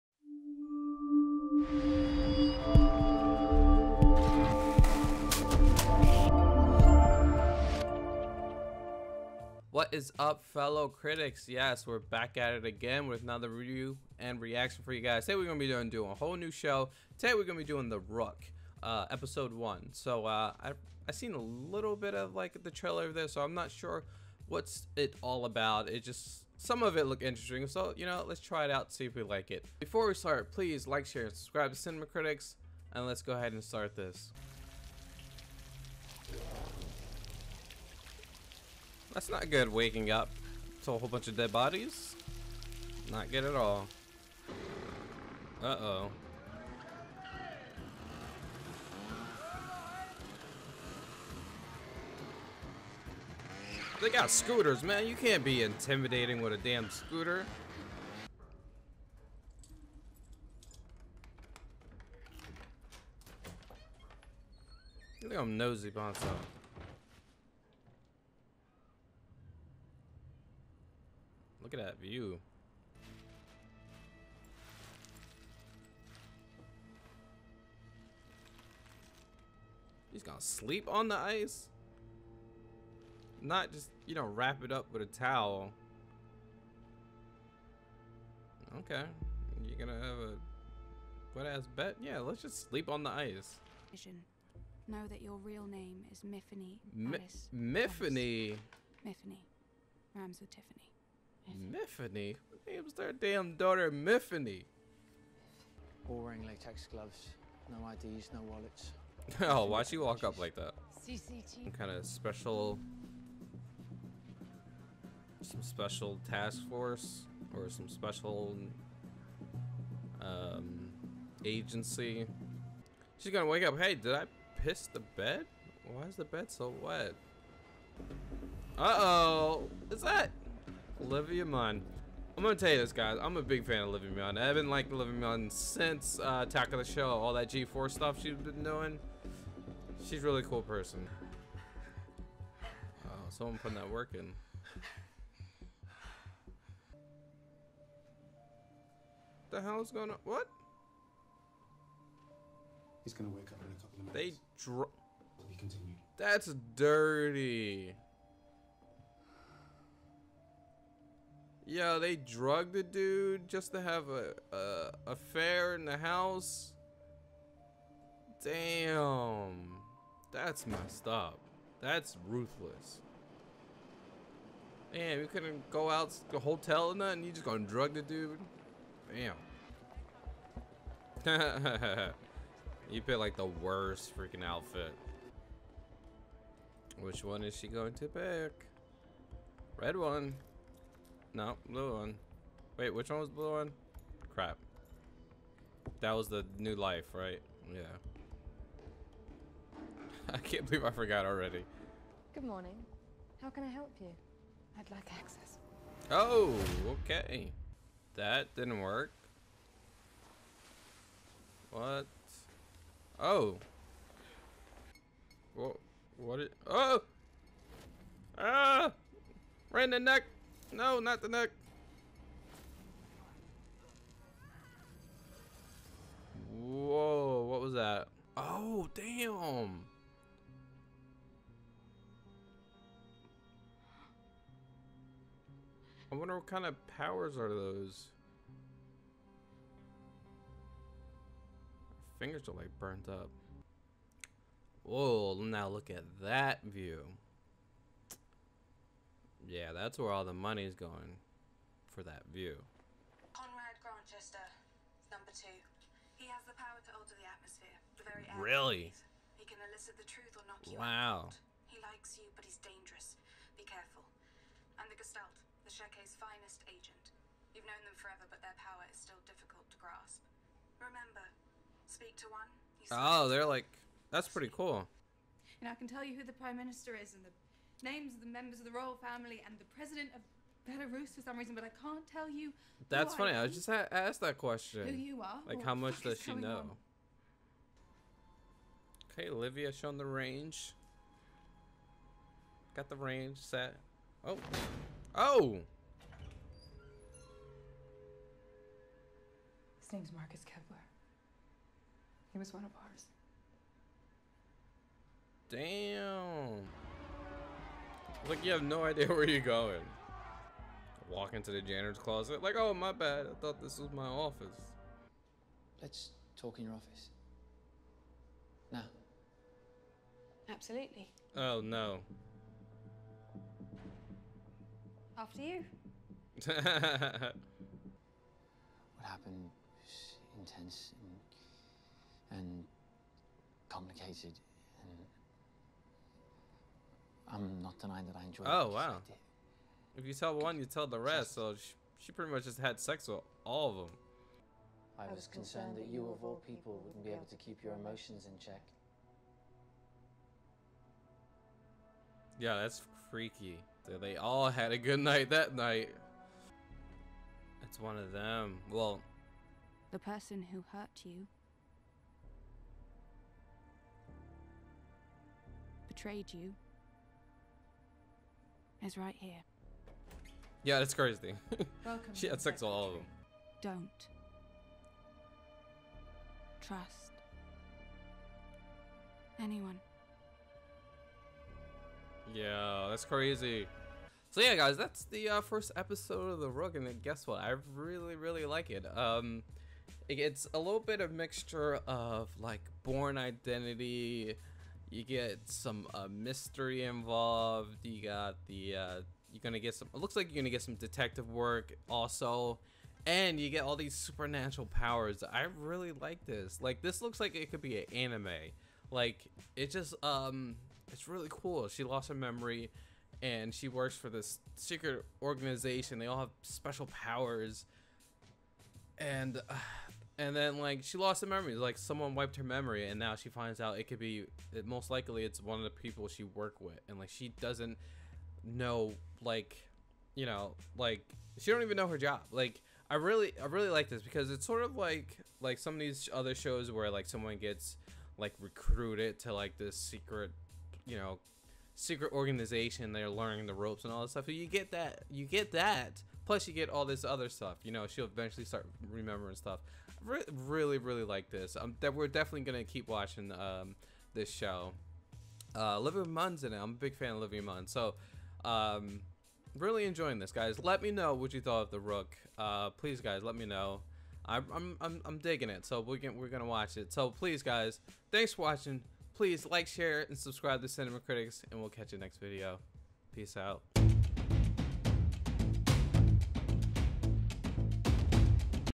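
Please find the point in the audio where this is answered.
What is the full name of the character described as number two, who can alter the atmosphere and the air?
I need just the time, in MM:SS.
04:13.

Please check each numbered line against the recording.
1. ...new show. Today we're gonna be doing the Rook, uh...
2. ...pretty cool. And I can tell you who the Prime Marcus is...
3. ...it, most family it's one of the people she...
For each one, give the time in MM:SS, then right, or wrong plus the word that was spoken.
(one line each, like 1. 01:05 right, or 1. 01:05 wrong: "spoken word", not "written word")
1. 00:16 right
2. 04:34 wrong: "Minister", not "Marcus"
3. 07:04 wrong: "likely", not "family".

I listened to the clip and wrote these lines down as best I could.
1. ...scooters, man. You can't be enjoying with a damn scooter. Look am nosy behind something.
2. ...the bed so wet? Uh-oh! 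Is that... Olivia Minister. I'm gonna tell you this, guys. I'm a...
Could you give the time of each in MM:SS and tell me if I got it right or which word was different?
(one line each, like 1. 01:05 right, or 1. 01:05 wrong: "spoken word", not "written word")
1. 00:54 wrong: "intimidating", not "enjoying"
2. 02:06 wrong: "Munn", not "Minister".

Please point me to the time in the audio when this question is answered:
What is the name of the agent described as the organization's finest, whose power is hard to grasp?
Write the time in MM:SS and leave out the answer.
04:24.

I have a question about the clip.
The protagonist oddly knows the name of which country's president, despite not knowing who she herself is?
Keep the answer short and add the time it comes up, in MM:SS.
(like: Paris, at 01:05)
Belarus, at 04:40.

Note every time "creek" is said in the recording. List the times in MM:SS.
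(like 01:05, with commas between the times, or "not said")
not said.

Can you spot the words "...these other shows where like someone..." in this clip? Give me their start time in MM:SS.
07:15.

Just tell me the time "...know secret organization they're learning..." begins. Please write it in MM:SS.
07:20.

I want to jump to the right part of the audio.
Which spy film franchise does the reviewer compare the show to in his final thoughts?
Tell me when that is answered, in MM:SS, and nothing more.
06:32.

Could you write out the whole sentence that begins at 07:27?
You know, she'll eventually start remembering stuff.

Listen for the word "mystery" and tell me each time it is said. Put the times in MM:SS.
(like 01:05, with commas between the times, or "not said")
06:36.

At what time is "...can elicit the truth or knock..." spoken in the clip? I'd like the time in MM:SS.
04:19.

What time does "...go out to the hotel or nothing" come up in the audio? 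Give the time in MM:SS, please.
02:55.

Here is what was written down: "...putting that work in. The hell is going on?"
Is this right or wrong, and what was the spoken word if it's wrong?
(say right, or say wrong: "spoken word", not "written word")
right.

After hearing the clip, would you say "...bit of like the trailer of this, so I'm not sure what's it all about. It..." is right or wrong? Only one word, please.
right.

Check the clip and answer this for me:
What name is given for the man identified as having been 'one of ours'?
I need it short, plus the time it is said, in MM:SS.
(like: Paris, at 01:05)
Marcus Kepler, at 05:00.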